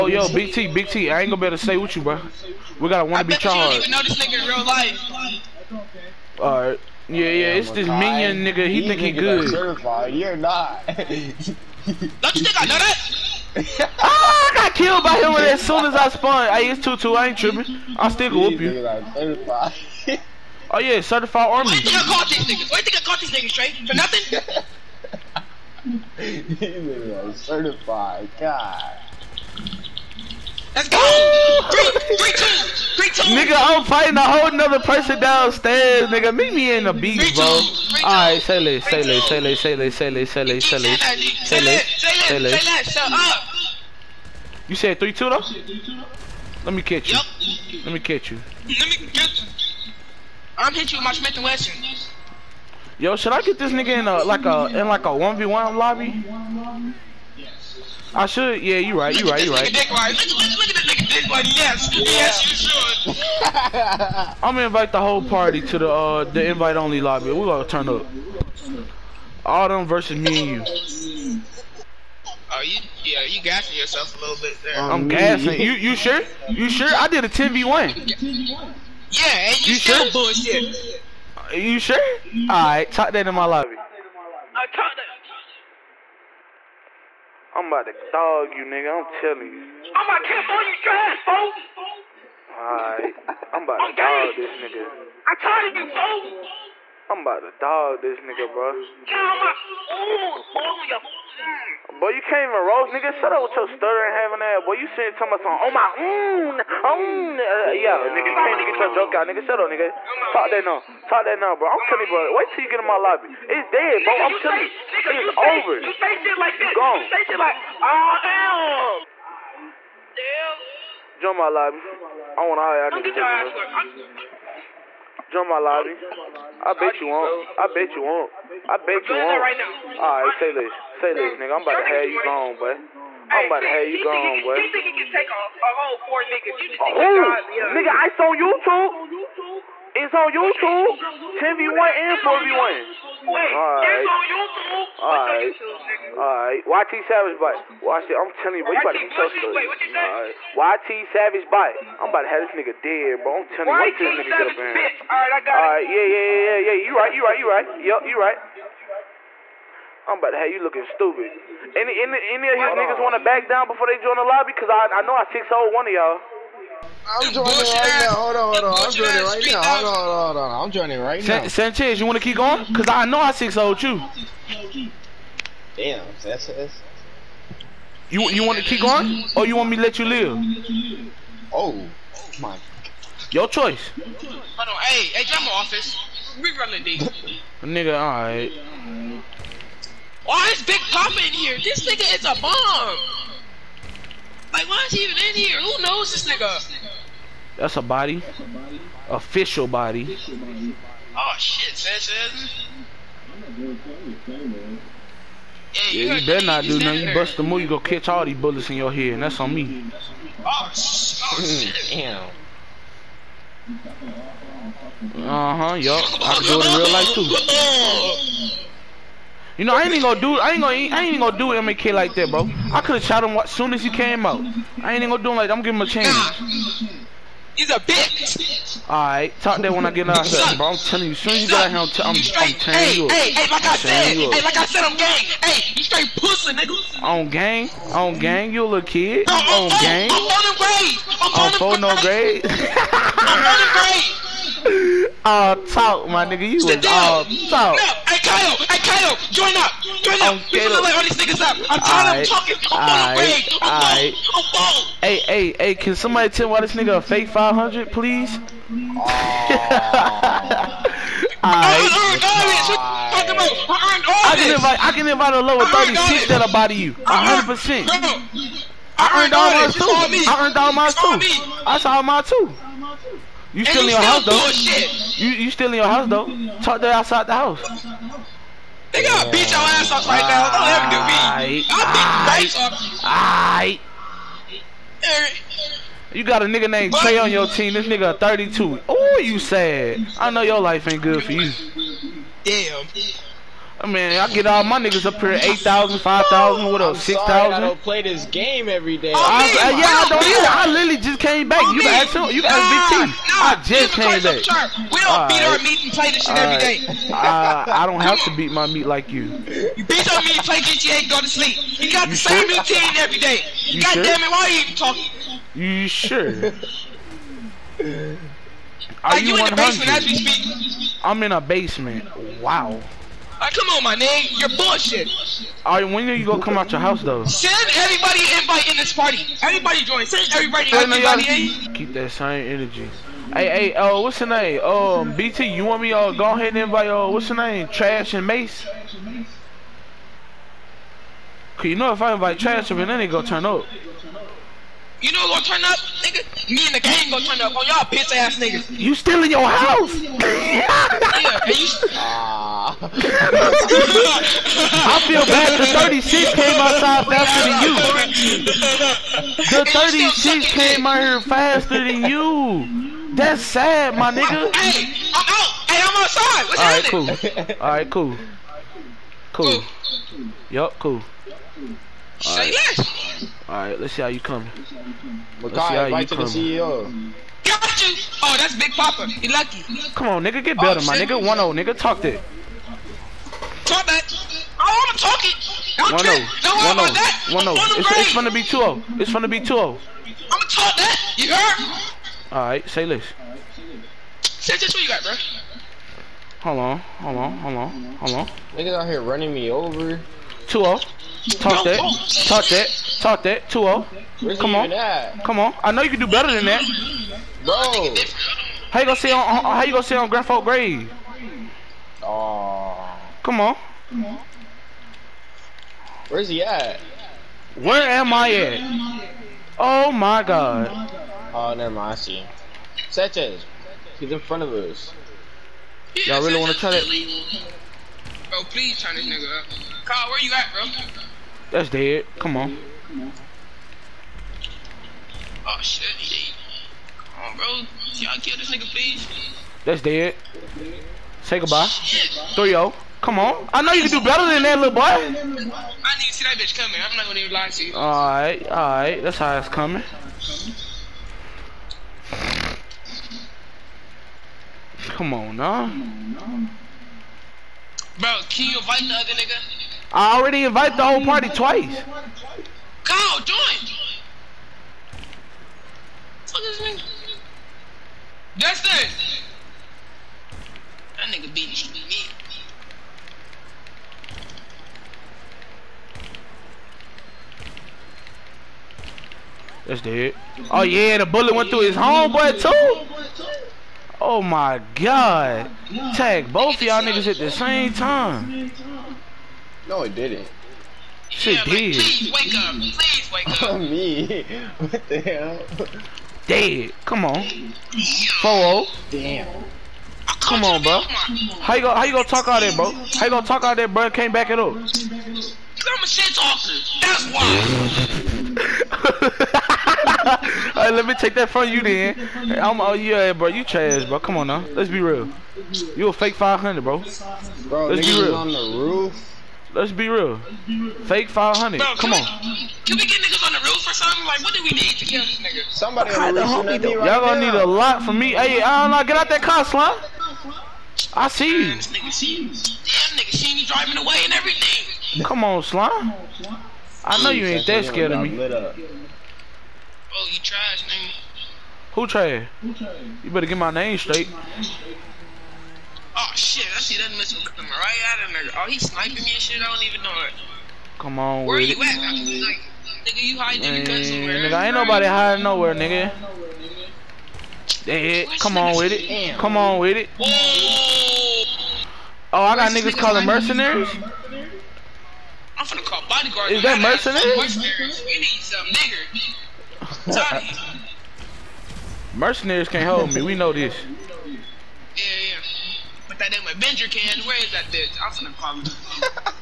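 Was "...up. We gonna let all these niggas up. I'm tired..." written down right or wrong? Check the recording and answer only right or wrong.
right.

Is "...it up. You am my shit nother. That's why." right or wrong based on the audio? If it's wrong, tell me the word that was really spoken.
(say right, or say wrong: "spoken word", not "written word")
wrong: "talker", not "nother".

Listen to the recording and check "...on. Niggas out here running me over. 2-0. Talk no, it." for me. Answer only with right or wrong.
right.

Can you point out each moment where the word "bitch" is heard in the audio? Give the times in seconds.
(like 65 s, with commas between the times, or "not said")
227 s, 347 s, 446 s, 577 s.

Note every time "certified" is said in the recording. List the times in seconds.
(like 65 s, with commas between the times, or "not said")
9 s, 20 s, 27 s.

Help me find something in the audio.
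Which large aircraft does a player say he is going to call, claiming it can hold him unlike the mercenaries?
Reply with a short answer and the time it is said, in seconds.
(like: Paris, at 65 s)
Avenger, at 576 s.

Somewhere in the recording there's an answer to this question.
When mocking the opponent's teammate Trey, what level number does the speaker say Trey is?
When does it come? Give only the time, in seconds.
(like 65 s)
288 s.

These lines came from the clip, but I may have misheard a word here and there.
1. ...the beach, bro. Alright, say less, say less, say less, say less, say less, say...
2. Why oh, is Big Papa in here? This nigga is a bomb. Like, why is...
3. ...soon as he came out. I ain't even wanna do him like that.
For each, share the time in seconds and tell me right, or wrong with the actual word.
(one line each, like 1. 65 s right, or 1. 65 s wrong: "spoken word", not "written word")
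1. 36 s right
2. 190 s right
3. 223 s wrong: "gonna", not "wanna".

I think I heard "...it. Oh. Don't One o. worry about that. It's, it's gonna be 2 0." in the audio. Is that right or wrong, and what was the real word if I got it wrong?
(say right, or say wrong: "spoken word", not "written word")
right.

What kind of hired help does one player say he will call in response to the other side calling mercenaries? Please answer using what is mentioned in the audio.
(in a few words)
bodyguards.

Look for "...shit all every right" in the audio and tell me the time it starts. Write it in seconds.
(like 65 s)
306 s.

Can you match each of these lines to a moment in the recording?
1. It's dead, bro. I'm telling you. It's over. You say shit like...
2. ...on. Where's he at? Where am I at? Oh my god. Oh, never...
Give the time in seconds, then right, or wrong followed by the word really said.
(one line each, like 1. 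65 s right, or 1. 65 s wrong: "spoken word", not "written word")
1. 113 s right
2. 413 s right.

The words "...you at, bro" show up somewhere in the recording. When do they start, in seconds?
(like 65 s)
430 s.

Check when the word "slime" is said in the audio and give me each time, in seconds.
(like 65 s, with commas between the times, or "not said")
529 s, 535 s.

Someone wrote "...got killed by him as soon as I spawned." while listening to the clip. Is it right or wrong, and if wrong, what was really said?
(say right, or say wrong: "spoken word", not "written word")
right.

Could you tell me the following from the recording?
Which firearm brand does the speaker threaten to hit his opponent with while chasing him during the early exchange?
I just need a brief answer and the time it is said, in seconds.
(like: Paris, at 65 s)
Smith and Wesson, at 51 s.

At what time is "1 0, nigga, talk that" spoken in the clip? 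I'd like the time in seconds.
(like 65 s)
381 s.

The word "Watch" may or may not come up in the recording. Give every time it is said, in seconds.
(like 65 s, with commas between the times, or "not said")
147 s, 153 s.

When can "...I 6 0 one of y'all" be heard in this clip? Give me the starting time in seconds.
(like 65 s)
165 s.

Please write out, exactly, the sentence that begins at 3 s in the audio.
You don't even know this nigga in real life.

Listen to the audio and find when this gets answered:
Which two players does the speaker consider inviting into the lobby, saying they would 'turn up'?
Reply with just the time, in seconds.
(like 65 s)
337 s.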